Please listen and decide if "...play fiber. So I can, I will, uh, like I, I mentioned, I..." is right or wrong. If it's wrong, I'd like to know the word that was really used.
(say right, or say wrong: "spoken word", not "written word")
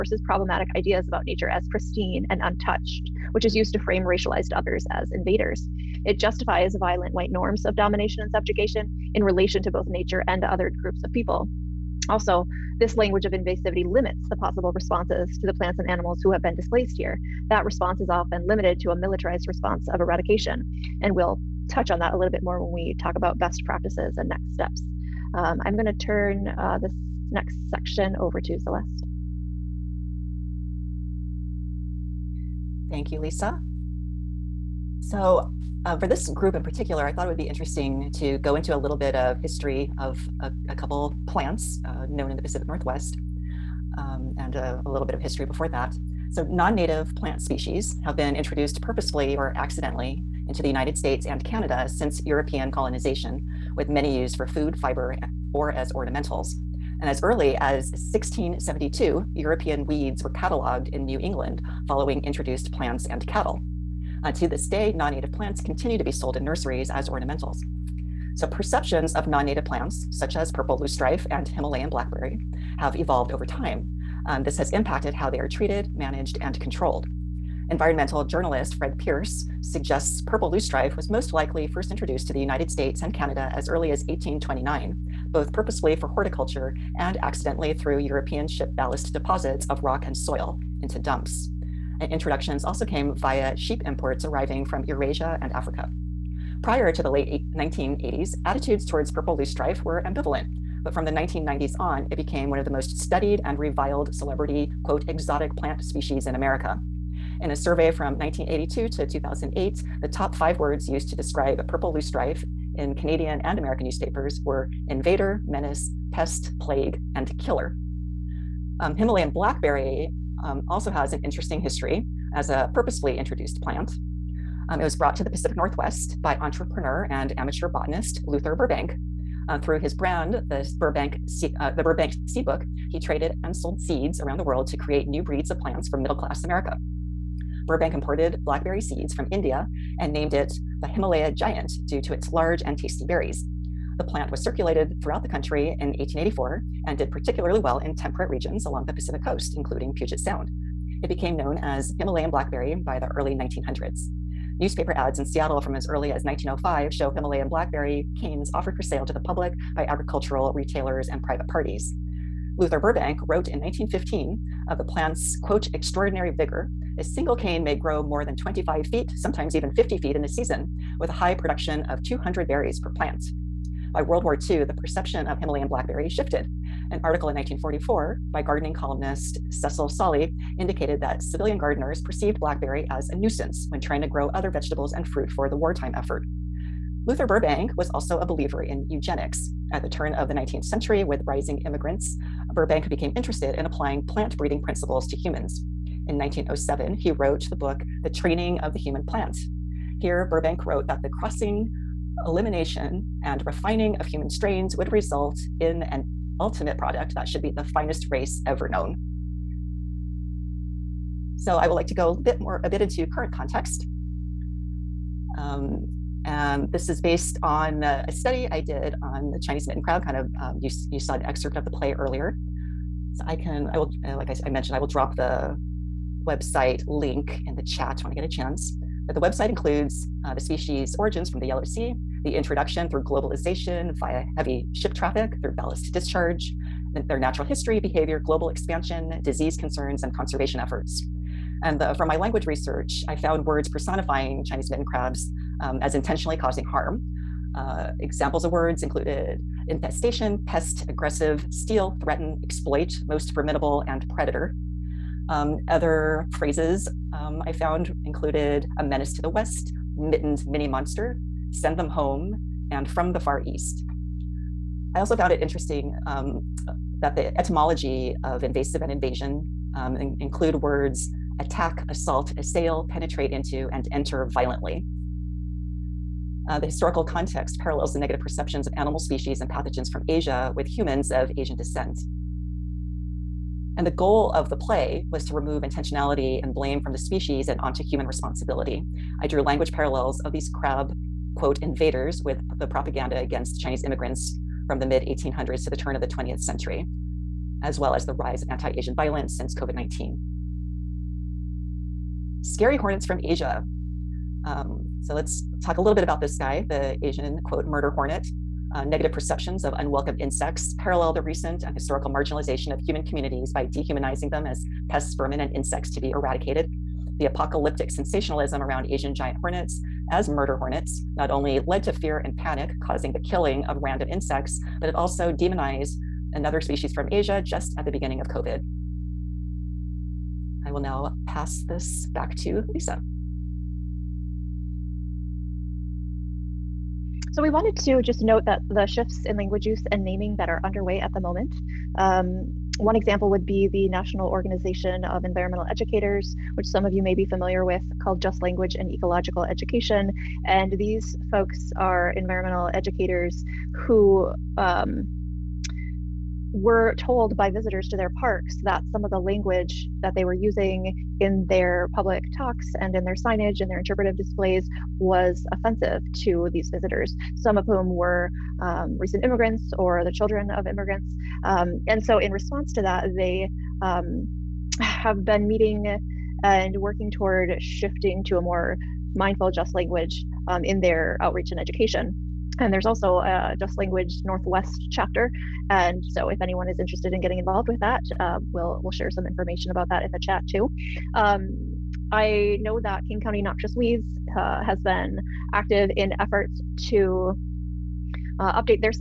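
wrong: "earlier", not "fiber".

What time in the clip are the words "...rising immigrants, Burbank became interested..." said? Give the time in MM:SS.
03:11.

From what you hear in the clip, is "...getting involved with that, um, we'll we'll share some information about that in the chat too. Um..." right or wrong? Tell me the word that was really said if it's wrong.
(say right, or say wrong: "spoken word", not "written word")
right.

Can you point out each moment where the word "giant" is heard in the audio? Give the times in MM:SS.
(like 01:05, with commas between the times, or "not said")
02:21, 05:19.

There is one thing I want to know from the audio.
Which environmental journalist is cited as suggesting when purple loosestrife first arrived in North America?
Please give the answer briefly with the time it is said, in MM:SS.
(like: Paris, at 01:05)
Fred Pearce, at 01:18.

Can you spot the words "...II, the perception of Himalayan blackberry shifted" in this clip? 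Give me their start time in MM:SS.
02:54.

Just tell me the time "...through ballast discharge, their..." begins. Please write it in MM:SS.
03:55.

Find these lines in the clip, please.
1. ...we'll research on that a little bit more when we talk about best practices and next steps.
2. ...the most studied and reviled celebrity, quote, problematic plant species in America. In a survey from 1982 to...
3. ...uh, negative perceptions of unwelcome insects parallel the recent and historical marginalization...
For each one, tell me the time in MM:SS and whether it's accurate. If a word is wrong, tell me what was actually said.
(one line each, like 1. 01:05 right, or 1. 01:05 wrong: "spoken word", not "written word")
1. 00:21 wrong: "touch", not "research"
2. 01:42 wrong: "exotic", not "problematic"
3. 05:08 right.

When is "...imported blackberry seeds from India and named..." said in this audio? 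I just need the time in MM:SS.
02:17.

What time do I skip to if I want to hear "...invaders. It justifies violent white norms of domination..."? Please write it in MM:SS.
00:05.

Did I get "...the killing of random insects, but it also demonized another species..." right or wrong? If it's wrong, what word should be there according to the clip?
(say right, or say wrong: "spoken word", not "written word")
right.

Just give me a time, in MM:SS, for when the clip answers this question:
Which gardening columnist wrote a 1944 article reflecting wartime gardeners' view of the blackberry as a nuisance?
02:59.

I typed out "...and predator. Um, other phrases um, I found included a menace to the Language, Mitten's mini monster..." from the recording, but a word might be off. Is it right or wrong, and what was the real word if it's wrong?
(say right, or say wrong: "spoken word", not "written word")
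wrong: "West", not "Language".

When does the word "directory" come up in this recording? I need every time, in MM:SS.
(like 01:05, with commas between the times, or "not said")
not said.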